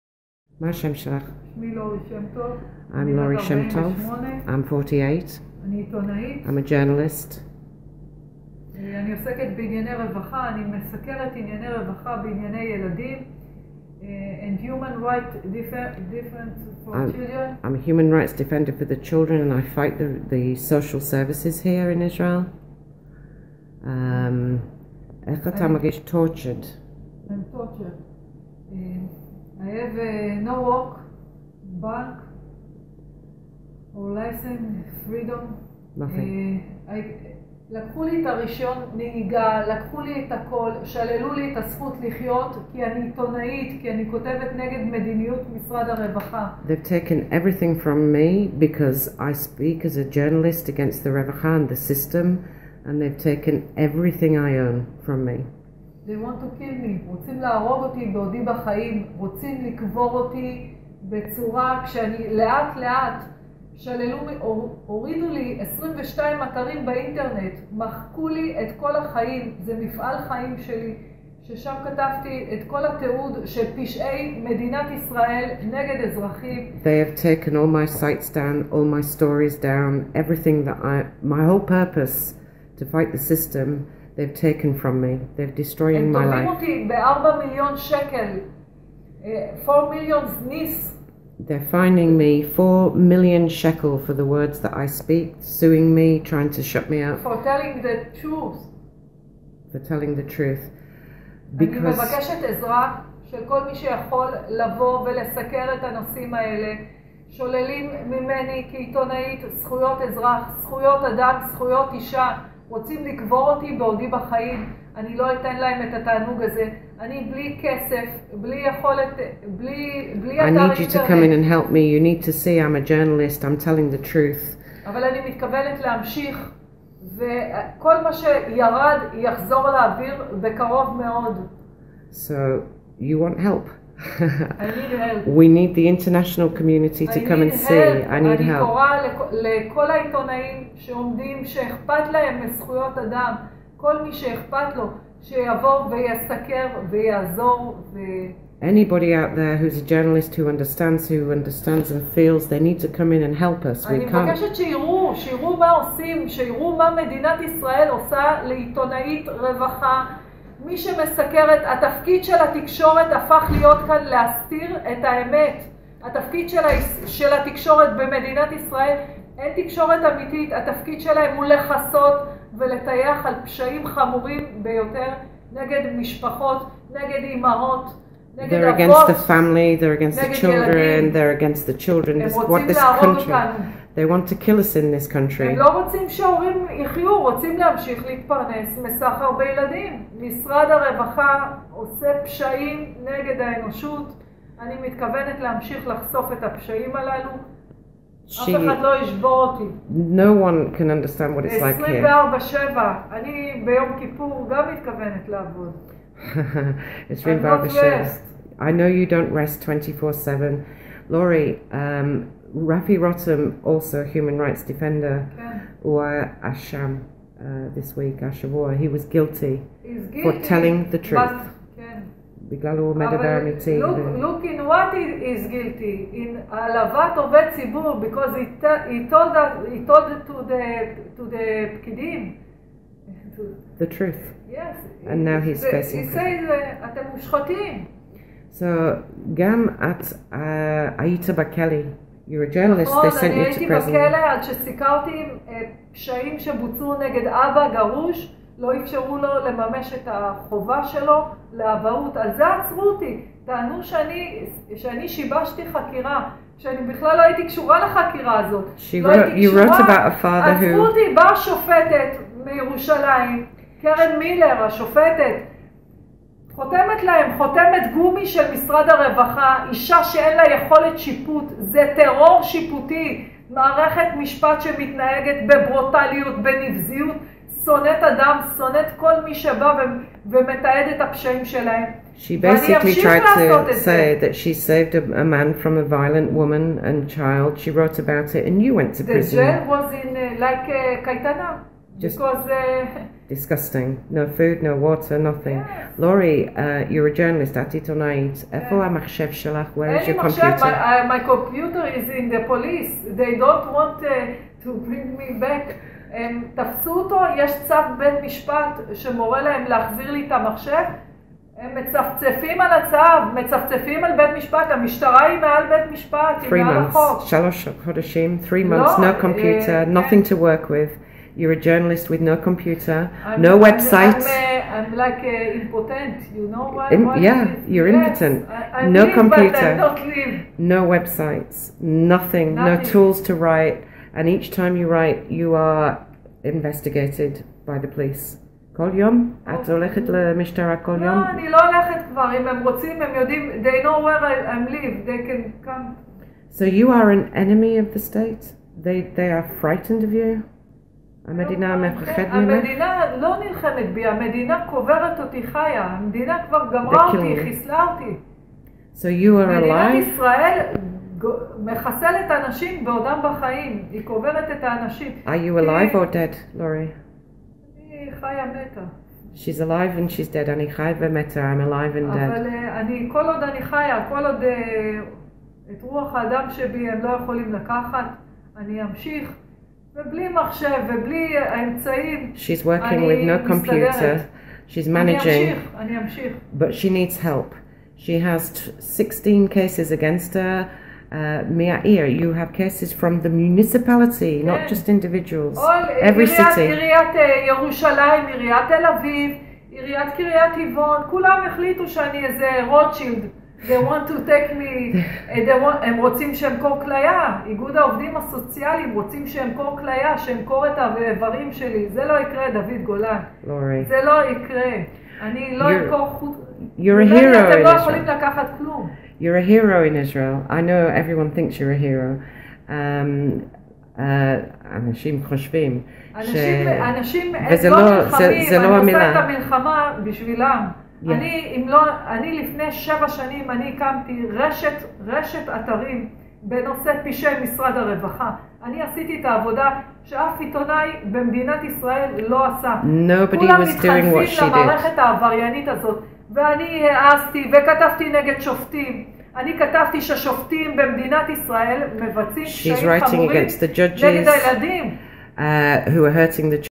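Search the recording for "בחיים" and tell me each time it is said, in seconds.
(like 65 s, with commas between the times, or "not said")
58 s, 114 s, 363 s.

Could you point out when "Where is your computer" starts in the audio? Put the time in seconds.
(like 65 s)
299 s.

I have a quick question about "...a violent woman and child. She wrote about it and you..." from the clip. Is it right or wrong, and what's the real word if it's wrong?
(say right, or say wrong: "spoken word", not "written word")
right.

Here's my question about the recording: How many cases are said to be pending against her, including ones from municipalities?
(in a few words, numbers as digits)
16.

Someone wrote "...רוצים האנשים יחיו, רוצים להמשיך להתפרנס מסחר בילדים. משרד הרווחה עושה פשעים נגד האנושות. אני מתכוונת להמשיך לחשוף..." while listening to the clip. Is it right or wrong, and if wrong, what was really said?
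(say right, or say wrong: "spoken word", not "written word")
wrong: "שהורים", not "האנשים".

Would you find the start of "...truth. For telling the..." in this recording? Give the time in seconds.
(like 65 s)
98 s.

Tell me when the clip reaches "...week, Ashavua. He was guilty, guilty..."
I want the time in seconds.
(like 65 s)
217 s.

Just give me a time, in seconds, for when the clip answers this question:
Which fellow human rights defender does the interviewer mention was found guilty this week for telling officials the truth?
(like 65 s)
212 s.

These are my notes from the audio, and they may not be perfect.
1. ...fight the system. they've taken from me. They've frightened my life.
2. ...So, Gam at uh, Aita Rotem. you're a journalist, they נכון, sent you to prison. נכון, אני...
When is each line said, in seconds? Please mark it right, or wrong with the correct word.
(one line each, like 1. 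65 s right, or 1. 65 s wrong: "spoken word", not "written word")
1. 82 s wrong: "destroyed", not "frightened"
2. 238 s wrong: "Bakeli", not "Rotem".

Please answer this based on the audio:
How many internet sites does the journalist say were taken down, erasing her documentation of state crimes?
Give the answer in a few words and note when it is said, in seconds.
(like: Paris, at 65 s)
22, at 65 s.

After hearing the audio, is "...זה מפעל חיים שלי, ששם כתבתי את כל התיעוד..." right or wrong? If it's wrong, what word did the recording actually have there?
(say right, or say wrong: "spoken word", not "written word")
right.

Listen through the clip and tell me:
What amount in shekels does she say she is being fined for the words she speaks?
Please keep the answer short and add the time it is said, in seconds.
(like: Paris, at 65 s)
4 million, at 92 s.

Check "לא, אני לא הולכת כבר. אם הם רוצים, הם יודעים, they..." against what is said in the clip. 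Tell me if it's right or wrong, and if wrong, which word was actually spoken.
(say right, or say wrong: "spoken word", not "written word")
right.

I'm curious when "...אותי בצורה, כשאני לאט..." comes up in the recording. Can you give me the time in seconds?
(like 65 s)
60 s.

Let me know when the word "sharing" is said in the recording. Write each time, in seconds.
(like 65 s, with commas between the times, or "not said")
not said.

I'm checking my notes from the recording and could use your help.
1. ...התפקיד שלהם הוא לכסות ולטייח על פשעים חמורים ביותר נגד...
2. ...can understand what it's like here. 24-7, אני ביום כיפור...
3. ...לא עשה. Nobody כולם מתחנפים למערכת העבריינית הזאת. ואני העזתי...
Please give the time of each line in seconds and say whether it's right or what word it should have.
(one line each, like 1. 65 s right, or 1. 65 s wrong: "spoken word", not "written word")
1. 170 s right
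2. 200 s right
3. 442 s right.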